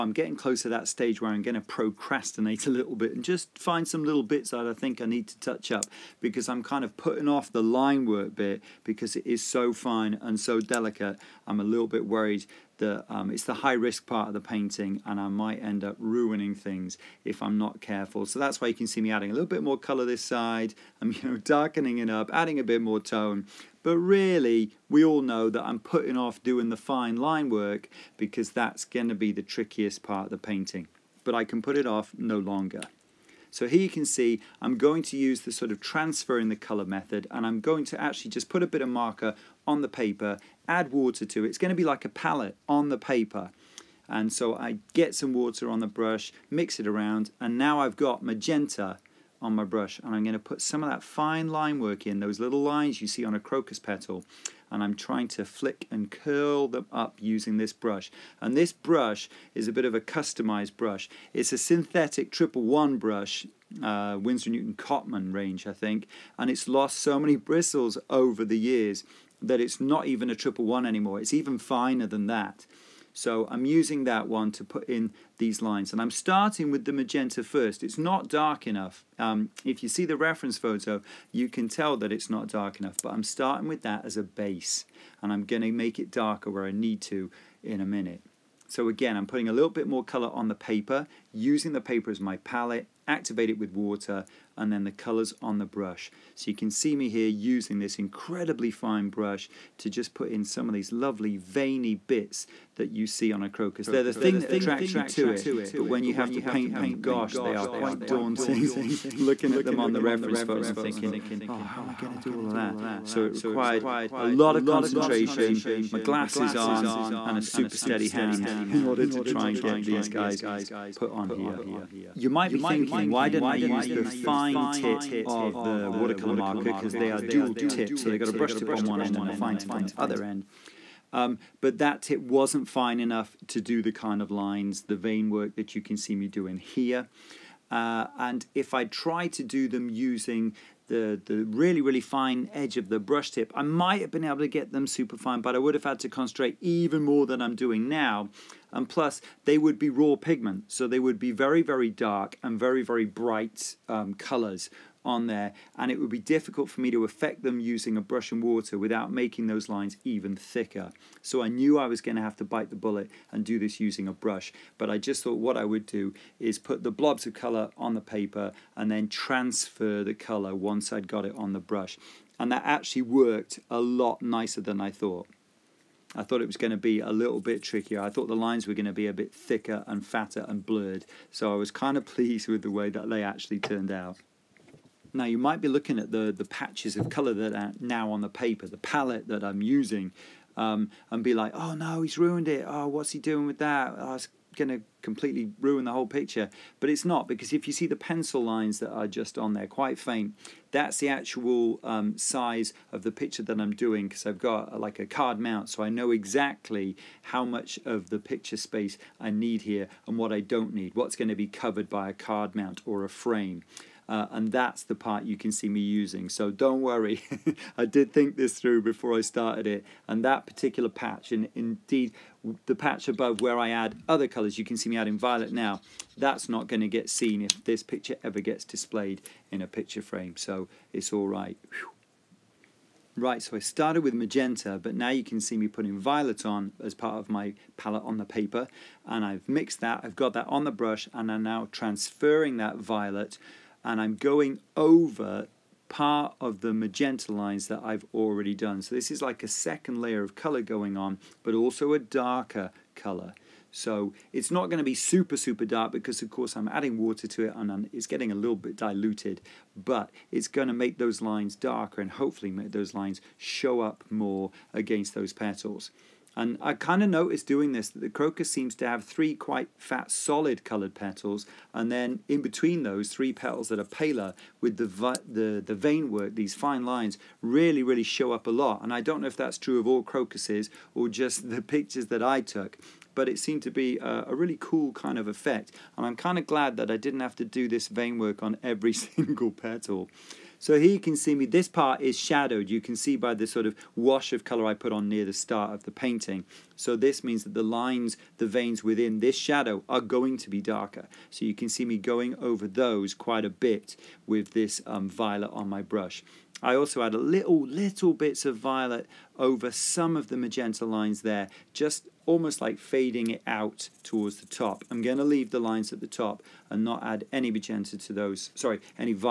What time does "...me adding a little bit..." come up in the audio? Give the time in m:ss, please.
0:19.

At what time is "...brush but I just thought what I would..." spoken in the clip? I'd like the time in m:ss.
2:44.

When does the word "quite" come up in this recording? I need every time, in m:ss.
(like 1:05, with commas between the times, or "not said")
1:47, 3:19, 4:29, 5:03.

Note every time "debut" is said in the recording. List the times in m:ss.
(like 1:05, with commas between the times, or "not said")
not said.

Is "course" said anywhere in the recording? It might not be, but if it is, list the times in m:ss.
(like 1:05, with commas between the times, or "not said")
4:16.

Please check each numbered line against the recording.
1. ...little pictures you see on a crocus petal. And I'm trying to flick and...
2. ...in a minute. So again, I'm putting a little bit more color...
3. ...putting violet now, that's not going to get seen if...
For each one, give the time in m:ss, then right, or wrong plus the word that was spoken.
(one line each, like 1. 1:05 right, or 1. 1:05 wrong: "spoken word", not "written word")
1. 0:52 wrong: "lines", not "pictures"
2. 1:27 right
3. 3:44 wrong: "adding", not "putting".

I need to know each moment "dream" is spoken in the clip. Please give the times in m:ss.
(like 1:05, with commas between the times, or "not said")
not said.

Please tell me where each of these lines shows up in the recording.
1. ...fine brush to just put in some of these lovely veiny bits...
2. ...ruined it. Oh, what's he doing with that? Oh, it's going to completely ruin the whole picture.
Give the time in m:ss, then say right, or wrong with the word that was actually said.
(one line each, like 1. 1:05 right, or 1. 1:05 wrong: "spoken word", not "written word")
1. 1:38 right
2. 3:12 right.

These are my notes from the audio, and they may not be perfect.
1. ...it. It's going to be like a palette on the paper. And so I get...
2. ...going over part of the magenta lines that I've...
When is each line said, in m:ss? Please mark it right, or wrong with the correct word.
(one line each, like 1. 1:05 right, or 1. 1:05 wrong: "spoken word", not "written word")
1. 0:41 right
2. 4:04 right.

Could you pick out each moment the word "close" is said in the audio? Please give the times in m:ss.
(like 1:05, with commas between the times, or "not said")
0:00.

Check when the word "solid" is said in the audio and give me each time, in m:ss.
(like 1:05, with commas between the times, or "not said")
4:30.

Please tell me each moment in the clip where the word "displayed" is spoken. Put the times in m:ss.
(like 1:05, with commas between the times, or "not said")
3:48.